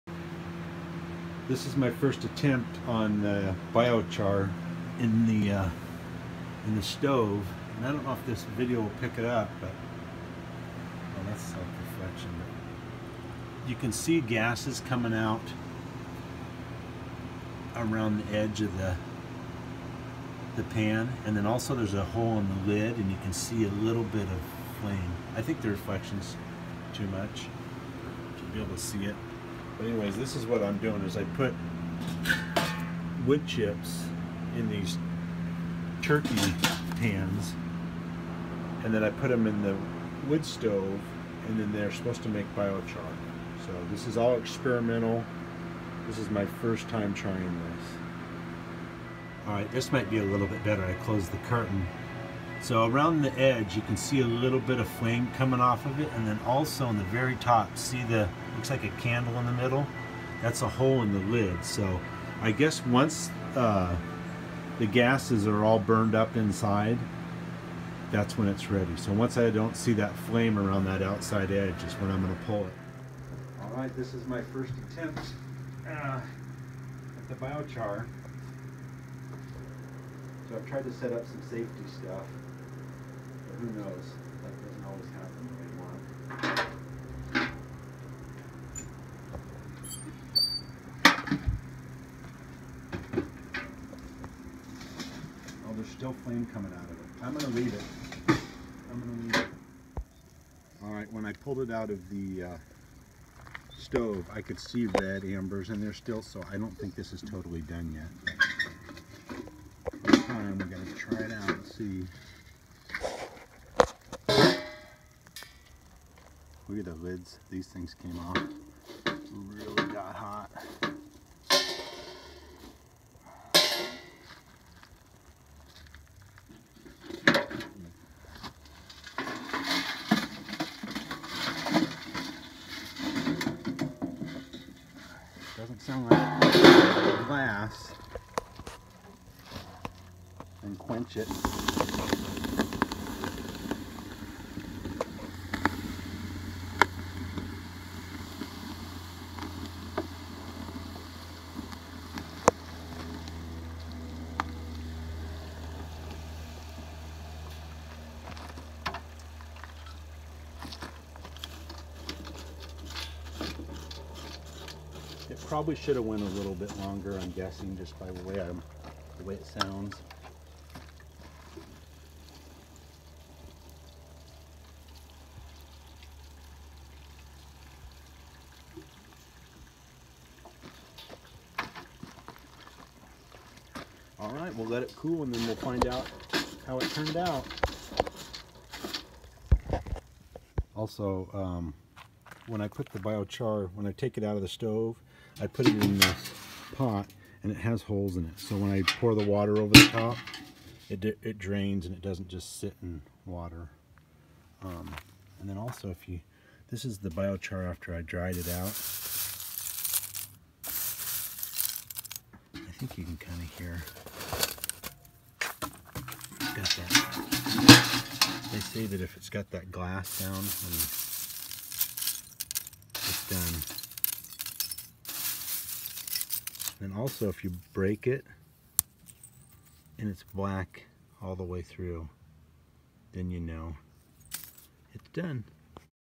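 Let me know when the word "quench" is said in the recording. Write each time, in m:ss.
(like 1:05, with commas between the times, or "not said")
2:20.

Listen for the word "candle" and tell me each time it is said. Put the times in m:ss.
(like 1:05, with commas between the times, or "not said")
0:59.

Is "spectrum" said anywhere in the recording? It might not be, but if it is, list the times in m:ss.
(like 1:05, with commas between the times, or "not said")
not said.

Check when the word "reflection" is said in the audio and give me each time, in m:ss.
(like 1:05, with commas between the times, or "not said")
0:11, 0:25.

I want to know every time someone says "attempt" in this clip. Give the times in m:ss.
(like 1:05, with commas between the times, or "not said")
0:02, 1:14.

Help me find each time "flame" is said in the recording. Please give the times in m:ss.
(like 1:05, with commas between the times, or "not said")
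0:24, 0:54, 1:10, 1:36.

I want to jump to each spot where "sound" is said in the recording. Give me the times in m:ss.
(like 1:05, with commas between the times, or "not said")
2:15, 2:49, 3:40.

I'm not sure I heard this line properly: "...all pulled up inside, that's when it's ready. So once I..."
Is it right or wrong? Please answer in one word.
wrong.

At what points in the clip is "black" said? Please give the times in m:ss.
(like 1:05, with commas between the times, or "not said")
3:50.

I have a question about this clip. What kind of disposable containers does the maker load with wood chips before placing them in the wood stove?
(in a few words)
Turkey pans.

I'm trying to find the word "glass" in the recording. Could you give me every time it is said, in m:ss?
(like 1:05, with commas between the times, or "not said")
2:17, 3:39.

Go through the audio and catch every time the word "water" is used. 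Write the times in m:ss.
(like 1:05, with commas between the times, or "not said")
3:19, 3:23.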